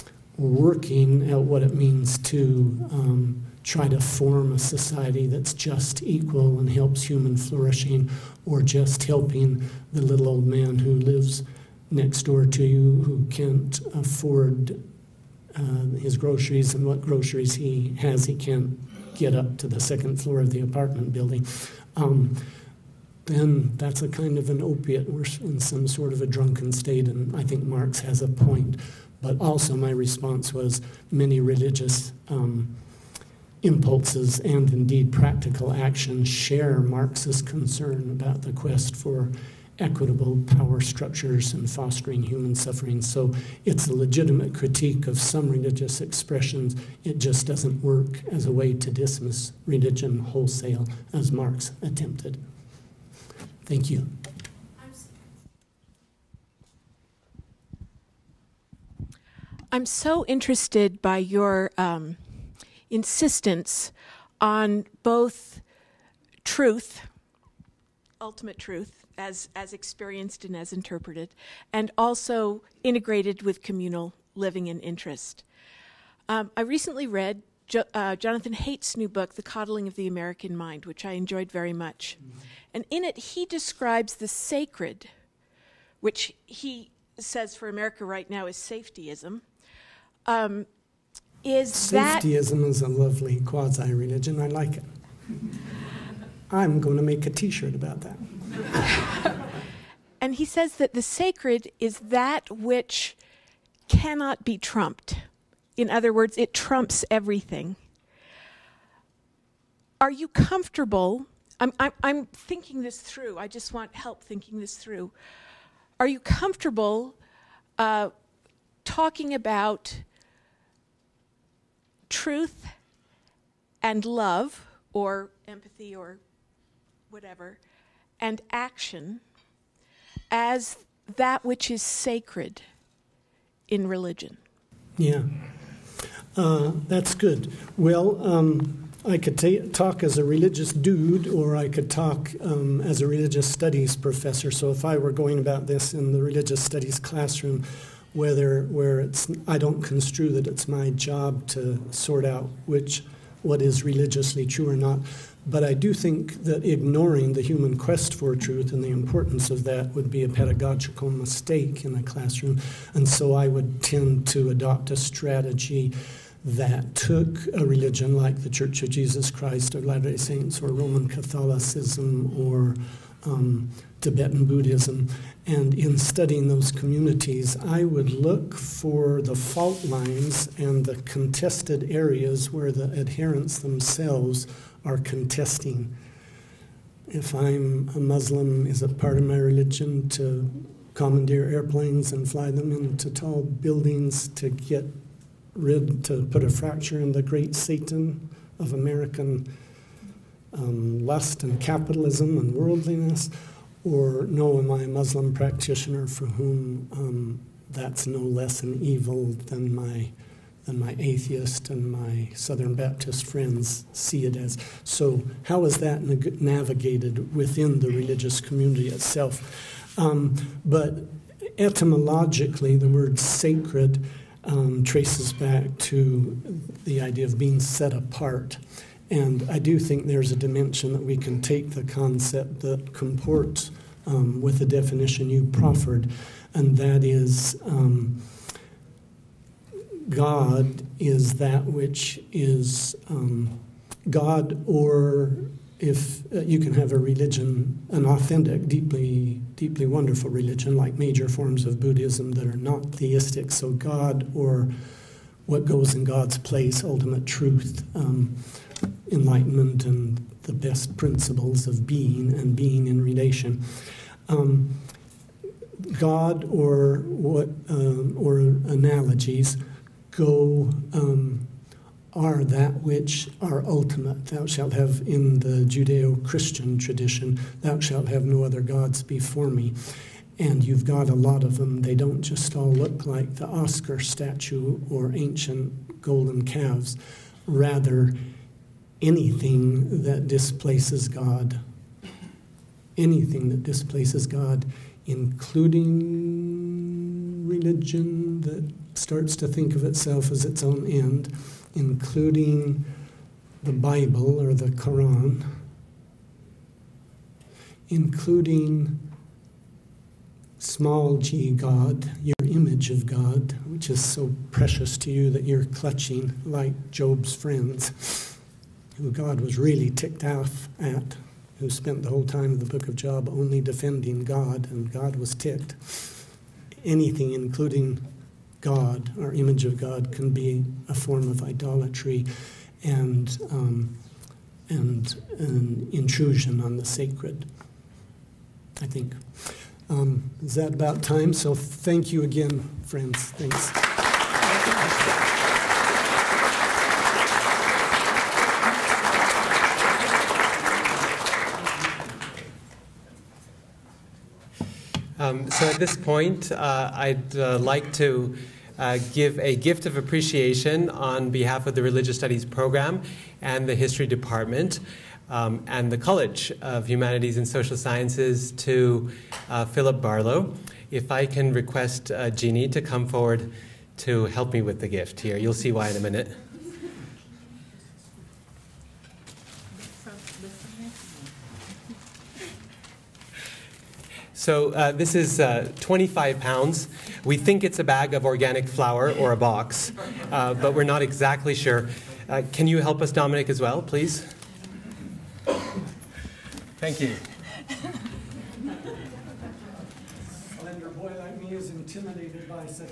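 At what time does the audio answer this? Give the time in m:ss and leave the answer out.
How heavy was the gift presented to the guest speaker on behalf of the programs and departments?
6:25.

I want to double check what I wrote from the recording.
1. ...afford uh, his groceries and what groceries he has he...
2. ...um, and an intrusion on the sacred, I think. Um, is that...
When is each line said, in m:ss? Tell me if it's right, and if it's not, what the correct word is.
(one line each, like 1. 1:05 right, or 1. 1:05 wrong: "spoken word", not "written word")
1. 0:13 right
2. 5:33 right.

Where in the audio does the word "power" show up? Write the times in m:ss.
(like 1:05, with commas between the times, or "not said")
0:40.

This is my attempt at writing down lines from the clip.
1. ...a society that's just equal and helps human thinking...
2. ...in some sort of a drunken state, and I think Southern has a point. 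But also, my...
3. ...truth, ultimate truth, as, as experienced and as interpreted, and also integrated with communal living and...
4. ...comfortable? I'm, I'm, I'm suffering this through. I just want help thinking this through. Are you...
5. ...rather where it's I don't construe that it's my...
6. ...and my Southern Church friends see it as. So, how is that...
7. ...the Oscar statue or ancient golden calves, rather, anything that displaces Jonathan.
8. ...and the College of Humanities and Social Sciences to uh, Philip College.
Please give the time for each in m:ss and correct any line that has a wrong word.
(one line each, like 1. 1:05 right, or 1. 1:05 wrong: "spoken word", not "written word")
1. 0:04 wrong: "flourishing", not "thinking"
2. 0:25 wrong: "Marx", not "Southern"
3. 1:06 right
4. 1:50 wrong: "thinking", not "suffering"
5. 2:28 wrong: "whether", not "rather"
6. 3:31 wrong: "Baptist", not "Church"
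7. 4:43 wrong: "God", not "Jonathan"
8. 6:05 wrong: "Barlow", not "College".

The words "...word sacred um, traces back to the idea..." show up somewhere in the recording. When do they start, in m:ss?
3:42.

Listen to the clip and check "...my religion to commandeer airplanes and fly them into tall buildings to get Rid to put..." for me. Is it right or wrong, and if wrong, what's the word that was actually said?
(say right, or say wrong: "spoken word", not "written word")
right.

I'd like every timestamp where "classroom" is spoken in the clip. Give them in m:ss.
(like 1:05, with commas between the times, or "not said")
2:26, 2:42.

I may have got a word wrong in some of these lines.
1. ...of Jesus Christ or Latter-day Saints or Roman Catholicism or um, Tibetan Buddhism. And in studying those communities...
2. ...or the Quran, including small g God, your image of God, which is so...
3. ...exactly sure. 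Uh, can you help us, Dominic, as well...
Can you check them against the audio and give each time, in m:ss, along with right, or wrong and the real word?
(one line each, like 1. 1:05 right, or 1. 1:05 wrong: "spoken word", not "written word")
1. 2:48 right
2. 5:04 right
3. 6:31 right.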